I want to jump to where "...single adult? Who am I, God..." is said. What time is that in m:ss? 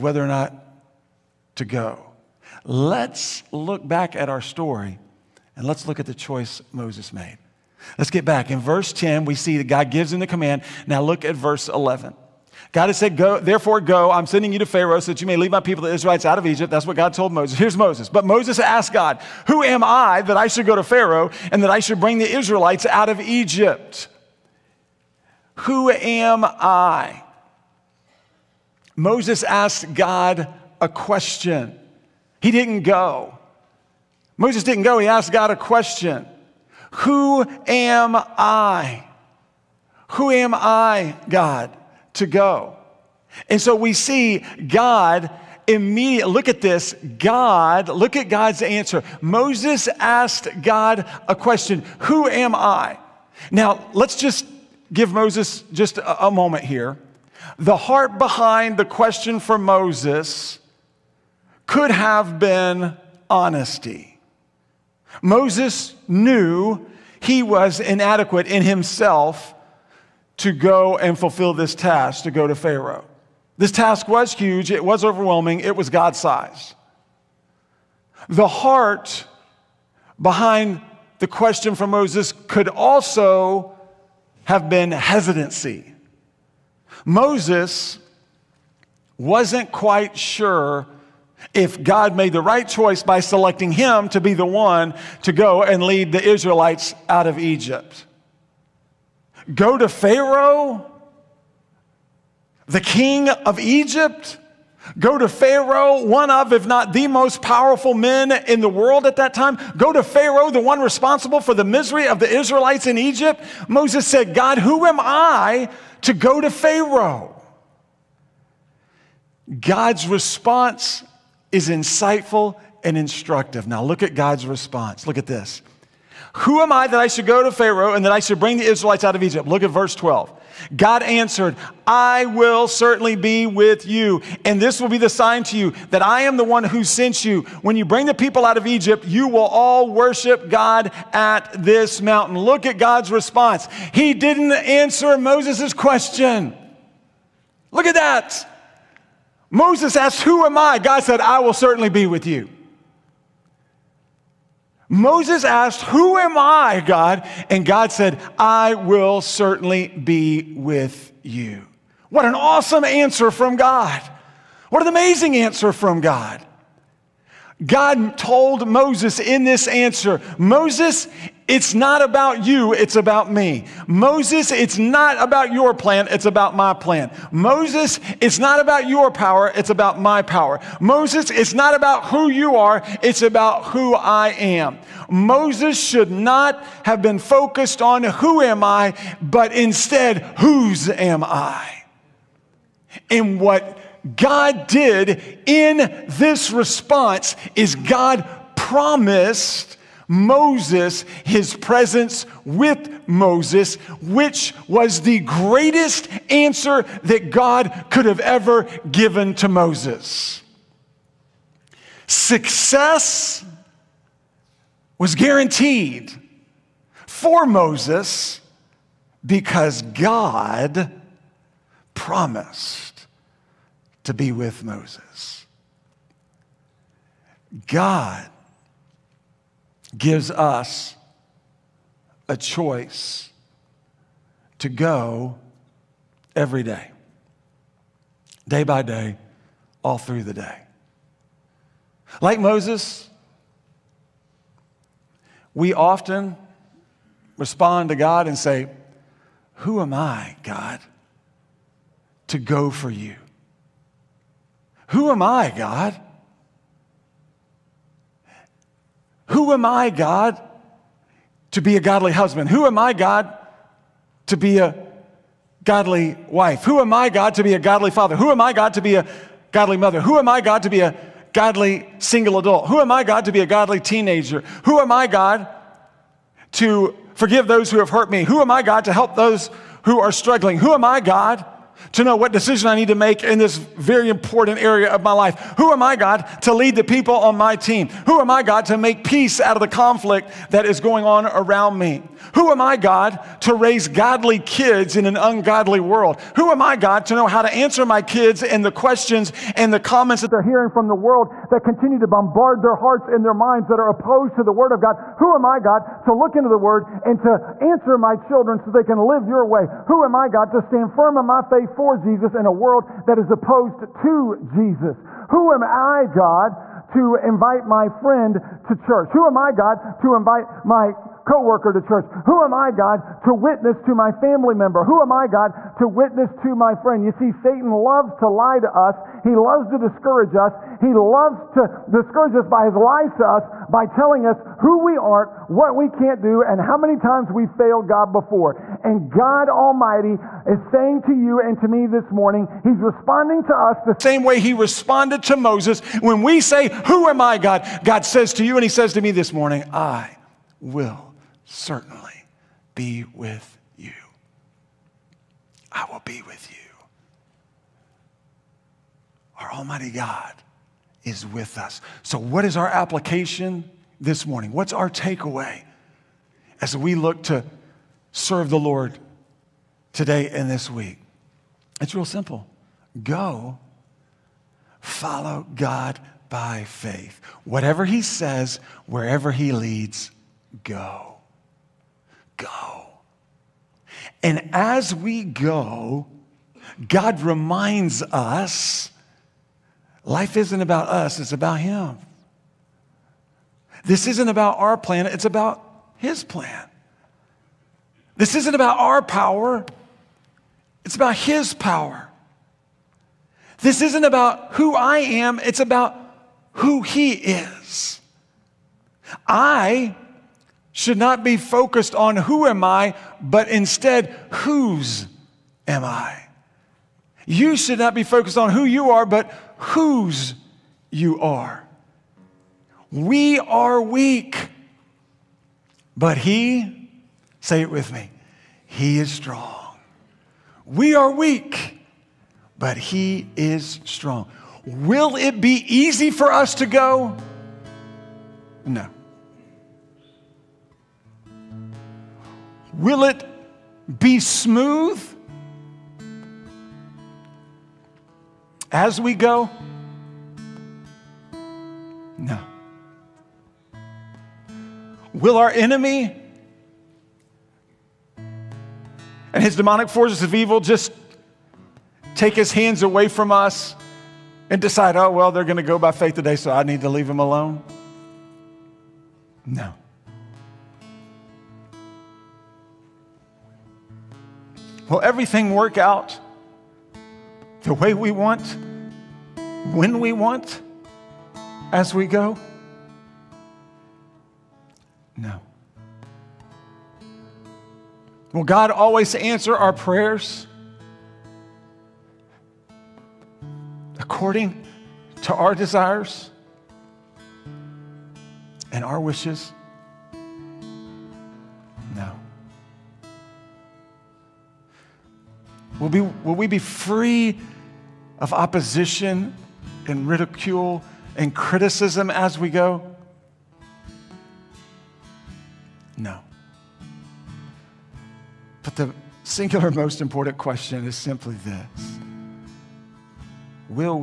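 4:31.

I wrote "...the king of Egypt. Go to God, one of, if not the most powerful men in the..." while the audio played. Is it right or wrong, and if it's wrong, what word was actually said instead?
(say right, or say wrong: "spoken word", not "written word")
wrong: "Pharaoh", not "God".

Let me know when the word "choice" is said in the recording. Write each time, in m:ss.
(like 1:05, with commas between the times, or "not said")
0:06, 1:32, 3:52.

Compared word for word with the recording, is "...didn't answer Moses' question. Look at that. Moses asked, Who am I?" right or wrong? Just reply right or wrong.
right.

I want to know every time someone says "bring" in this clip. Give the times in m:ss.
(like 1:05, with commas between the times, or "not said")
0:22, 2:08, 2:17.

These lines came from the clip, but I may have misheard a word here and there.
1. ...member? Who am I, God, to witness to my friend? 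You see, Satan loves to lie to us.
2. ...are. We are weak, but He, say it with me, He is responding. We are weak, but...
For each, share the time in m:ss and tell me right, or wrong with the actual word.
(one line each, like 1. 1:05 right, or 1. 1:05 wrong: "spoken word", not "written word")
1. 5:24 right
2. 7:01 wrong: "strong", not "responding".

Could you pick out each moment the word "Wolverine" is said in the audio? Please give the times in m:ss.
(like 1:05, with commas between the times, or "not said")
not said.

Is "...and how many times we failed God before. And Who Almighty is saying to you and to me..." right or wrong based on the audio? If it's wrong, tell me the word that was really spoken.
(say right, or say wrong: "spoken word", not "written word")
wrong: "God", not "Who".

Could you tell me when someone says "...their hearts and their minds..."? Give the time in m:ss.
5:02.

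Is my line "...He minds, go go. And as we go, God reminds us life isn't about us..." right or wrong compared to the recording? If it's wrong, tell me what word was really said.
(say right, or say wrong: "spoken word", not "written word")
wrong: "leads", not "minds".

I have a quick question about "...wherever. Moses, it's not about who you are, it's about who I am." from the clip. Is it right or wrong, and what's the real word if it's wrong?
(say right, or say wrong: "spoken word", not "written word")
wrong: "power", not "wherever".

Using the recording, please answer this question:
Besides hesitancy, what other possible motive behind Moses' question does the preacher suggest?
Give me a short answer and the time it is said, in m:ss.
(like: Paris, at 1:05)
honesty, at 1:03.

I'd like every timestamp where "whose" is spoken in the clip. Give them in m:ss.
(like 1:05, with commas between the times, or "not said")
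3:10, 6:54, 6:59.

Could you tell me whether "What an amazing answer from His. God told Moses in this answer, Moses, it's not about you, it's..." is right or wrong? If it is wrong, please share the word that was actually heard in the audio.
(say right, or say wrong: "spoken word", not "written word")
wrong: "God", not "His".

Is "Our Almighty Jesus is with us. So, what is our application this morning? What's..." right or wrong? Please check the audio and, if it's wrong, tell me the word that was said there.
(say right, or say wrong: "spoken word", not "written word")
wrong: "God", not "Jesus".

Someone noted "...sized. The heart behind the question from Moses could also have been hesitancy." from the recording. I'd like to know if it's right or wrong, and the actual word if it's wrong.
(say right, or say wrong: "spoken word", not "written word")
right.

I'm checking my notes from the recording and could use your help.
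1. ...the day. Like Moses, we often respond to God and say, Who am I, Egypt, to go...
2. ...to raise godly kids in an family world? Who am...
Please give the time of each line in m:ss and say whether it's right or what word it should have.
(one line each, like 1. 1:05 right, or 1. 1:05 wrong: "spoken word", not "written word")
1. 4:00 wrong: "God", not "Egypt"
2. 4:53 wrong: "ungodly", not "family".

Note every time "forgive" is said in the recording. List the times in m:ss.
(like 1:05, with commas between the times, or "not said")
4:37.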